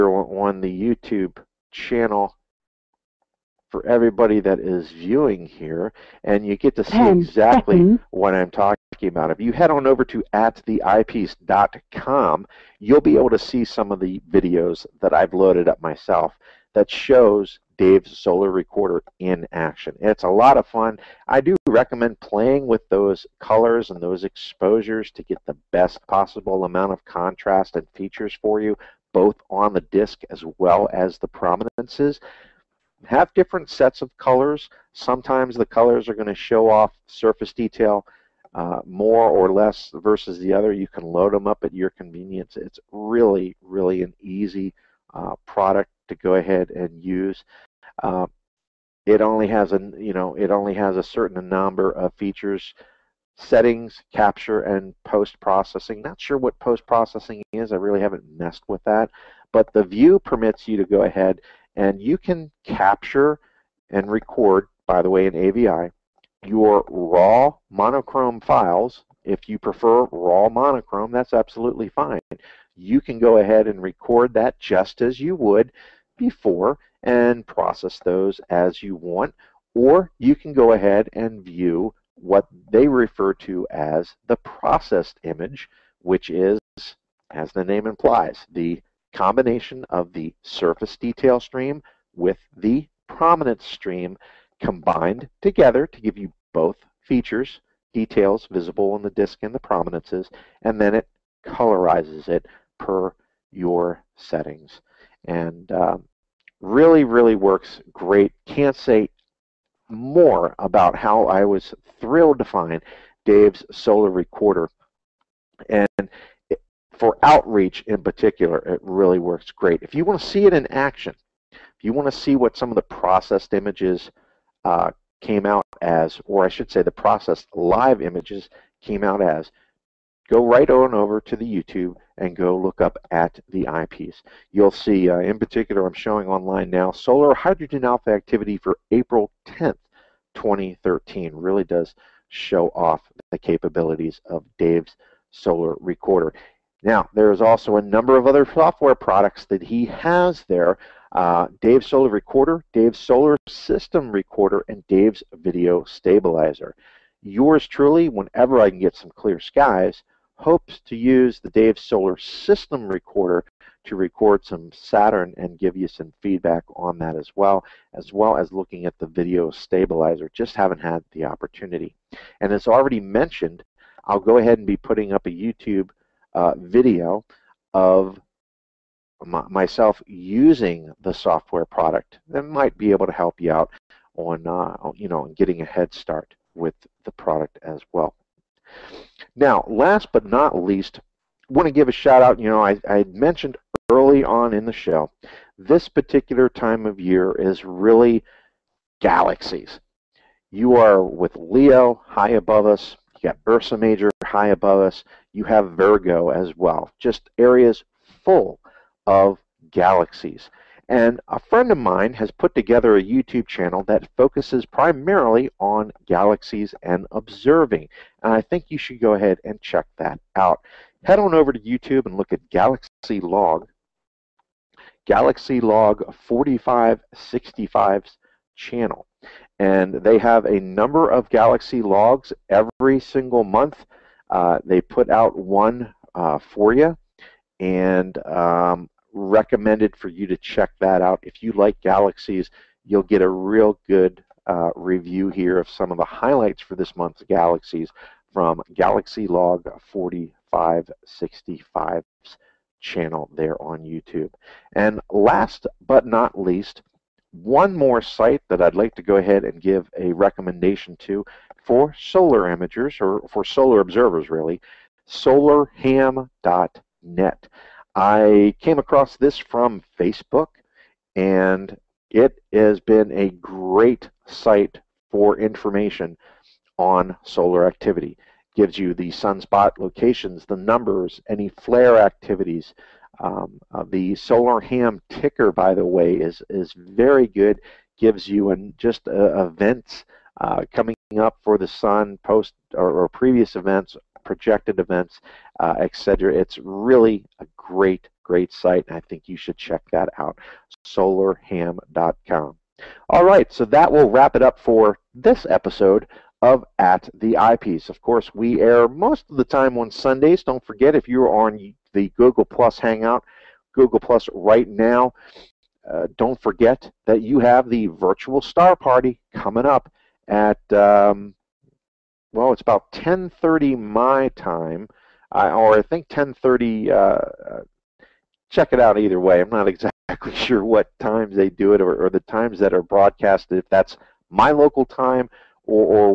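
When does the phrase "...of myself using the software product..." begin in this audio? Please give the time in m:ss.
2:57.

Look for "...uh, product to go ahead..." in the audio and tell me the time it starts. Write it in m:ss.
0:45.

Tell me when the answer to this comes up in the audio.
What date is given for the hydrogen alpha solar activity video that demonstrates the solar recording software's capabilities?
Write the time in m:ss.
2:18.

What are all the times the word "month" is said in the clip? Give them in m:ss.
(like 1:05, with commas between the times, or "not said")
3:53, 4:06.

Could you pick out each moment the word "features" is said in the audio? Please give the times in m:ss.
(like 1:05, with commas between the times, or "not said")
0:27, 0:52, 1:37.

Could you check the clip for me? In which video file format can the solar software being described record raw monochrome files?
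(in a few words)
AVI.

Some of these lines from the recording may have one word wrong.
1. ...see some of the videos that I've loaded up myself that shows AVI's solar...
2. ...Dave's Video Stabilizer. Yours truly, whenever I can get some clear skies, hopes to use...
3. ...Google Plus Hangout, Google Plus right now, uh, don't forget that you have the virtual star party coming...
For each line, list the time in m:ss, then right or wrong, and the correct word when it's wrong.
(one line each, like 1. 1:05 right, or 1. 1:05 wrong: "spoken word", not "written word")
1. 0:13 wrong: "Dave", not "AVI"
2. 2:34 right
3. 5:12 right.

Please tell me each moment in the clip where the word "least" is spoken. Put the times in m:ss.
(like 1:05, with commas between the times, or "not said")
3:10, 4:16.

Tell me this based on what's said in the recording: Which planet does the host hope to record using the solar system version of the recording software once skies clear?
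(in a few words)
Saturn.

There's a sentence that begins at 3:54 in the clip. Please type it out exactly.
Uh, they put out one uh, for you, and um, recommended for you to check that out.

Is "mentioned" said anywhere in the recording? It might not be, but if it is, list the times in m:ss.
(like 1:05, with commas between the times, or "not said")
2:52, 3:13.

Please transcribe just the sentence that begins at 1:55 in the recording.
And for outreach in particular, it really works great.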